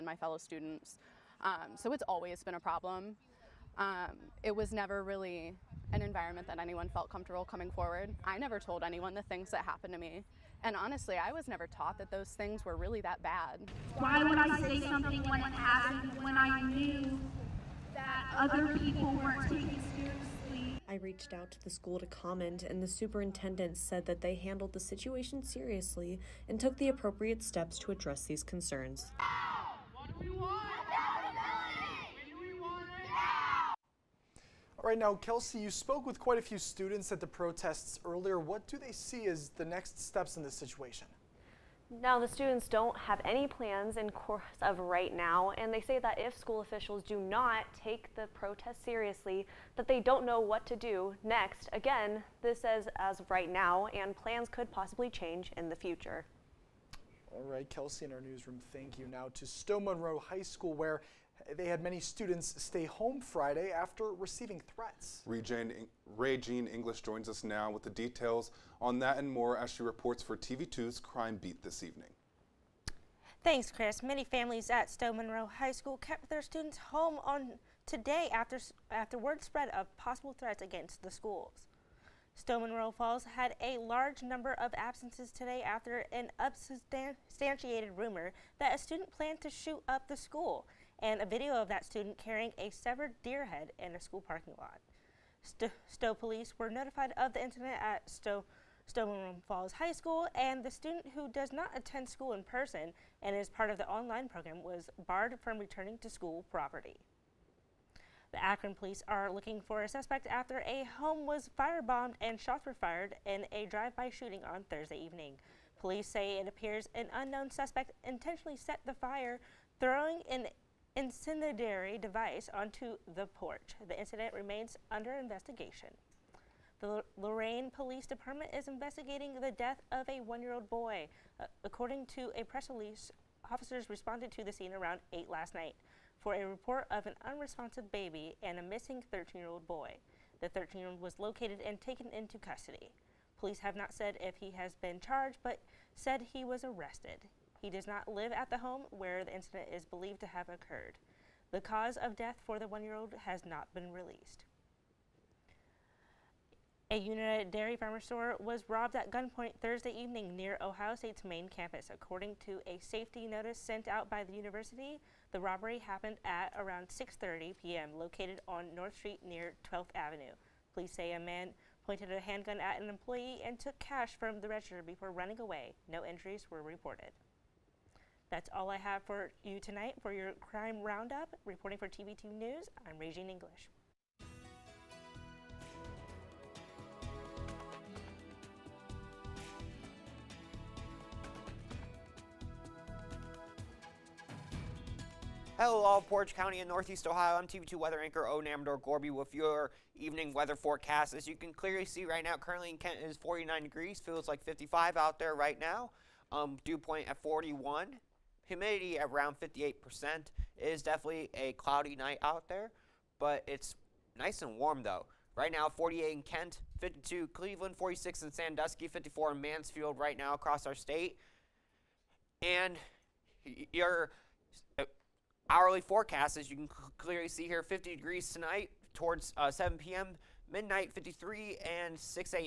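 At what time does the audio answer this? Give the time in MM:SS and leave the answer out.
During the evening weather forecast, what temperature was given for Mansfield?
03:38.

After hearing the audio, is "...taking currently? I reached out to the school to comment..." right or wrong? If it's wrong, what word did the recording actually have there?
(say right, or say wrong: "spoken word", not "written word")
wrong: "seriously", not "currently".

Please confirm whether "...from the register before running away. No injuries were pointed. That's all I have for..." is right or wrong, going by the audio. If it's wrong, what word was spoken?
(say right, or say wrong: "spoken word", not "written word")
wrong: "reported", not "pointed".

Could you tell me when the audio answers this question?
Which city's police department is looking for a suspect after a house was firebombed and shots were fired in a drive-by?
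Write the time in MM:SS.
01:48.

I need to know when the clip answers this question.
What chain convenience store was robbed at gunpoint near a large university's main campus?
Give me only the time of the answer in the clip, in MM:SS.
02:36.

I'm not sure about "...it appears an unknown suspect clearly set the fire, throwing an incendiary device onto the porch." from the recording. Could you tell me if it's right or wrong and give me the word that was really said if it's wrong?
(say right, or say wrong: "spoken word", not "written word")
wrong: "intentionally", not "clearly".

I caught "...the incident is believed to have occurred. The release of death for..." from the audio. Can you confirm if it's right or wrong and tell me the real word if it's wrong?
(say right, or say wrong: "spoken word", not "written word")
wrong: "cause", not "release".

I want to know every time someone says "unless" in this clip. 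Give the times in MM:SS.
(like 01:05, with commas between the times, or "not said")
not said.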